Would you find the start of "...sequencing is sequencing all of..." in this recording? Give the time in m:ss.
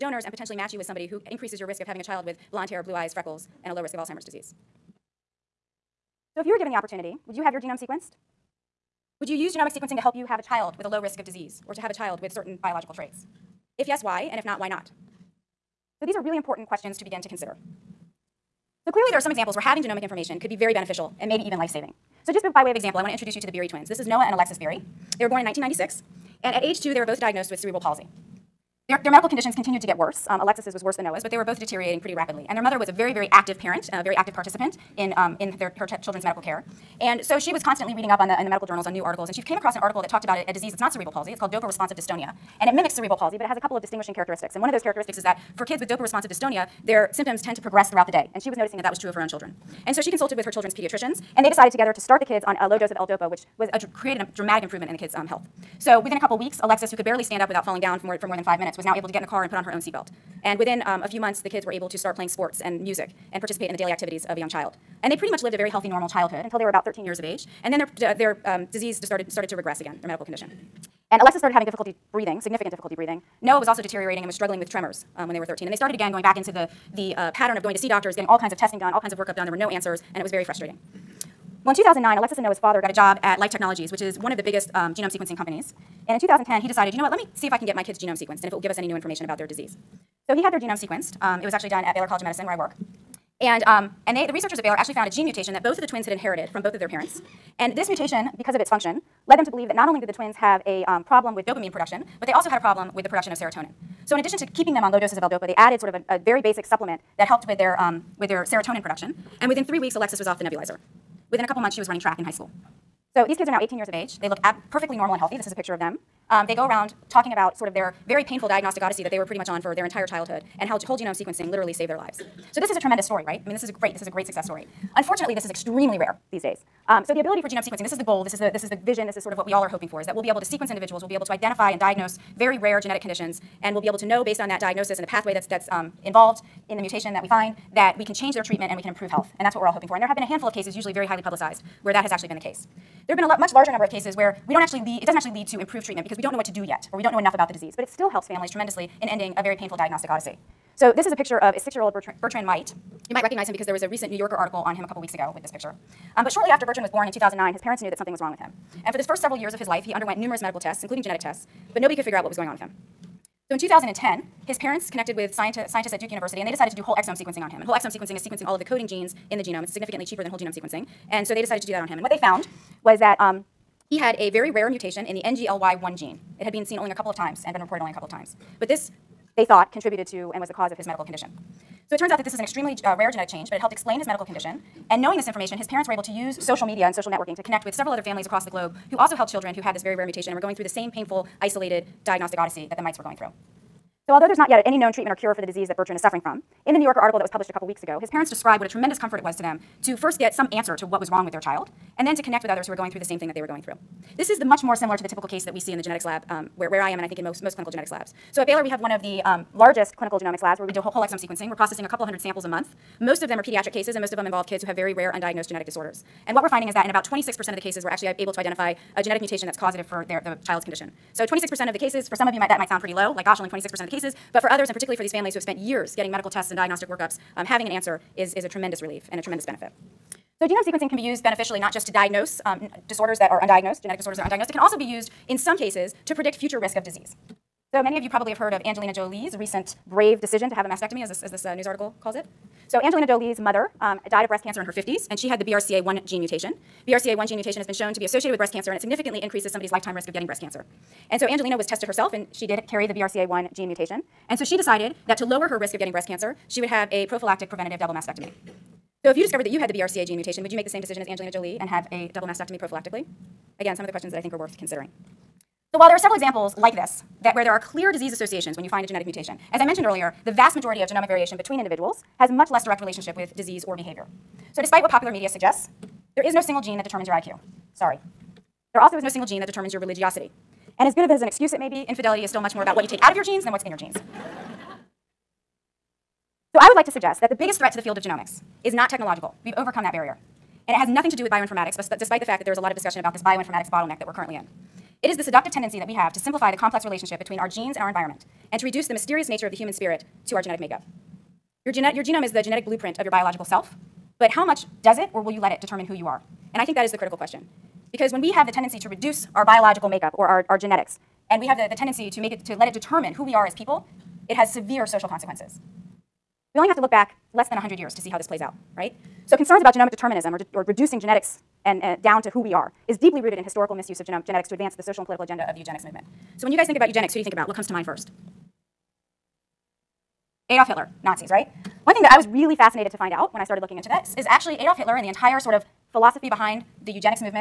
2:47.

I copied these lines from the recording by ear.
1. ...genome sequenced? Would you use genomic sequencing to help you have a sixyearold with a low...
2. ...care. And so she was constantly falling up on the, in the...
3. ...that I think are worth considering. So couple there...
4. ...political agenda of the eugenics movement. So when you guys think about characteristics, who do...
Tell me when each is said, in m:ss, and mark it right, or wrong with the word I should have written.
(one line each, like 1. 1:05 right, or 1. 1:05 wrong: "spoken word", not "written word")
1. 0:07 wrong: "child", not "sixyearold"
2. 0:36 wrong: "reading", not "falling"
3. 4:24 wrong: "while", not "couple"
4. 5:25 wrong: "eugenics", not "characteristics".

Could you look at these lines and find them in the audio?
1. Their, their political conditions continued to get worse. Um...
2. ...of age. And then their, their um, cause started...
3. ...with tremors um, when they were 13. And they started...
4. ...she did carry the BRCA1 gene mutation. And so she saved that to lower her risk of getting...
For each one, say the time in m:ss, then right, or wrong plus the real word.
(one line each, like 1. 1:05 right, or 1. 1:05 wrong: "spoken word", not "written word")
1. 0:28 wrong: "medical", not "political"
2. 1:07 wrong: "disease", not "cause"
3. 1:14 right
4. 4:12 wrong: "decided", not "saved".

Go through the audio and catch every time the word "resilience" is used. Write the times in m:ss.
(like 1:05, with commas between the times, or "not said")
not said.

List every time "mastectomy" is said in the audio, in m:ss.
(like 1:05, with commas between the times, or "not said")
4:00, 4:17, 4:22.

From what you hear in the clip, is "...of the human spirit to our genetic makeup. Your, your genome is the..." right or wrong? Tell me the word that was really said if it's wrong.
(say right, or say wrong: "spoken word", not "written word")
right.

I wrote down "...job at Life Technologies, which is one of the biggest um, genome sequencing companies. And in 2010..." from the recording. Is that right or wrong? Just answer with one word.
right.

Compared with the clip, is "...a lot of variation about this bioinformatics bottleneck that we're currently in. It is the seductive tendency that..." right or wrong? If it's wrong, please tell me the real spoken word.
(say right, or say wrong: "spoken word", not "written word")
wrong: "discussion", not "variation".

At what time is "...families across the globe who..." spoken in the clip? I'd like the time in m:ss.
3:08.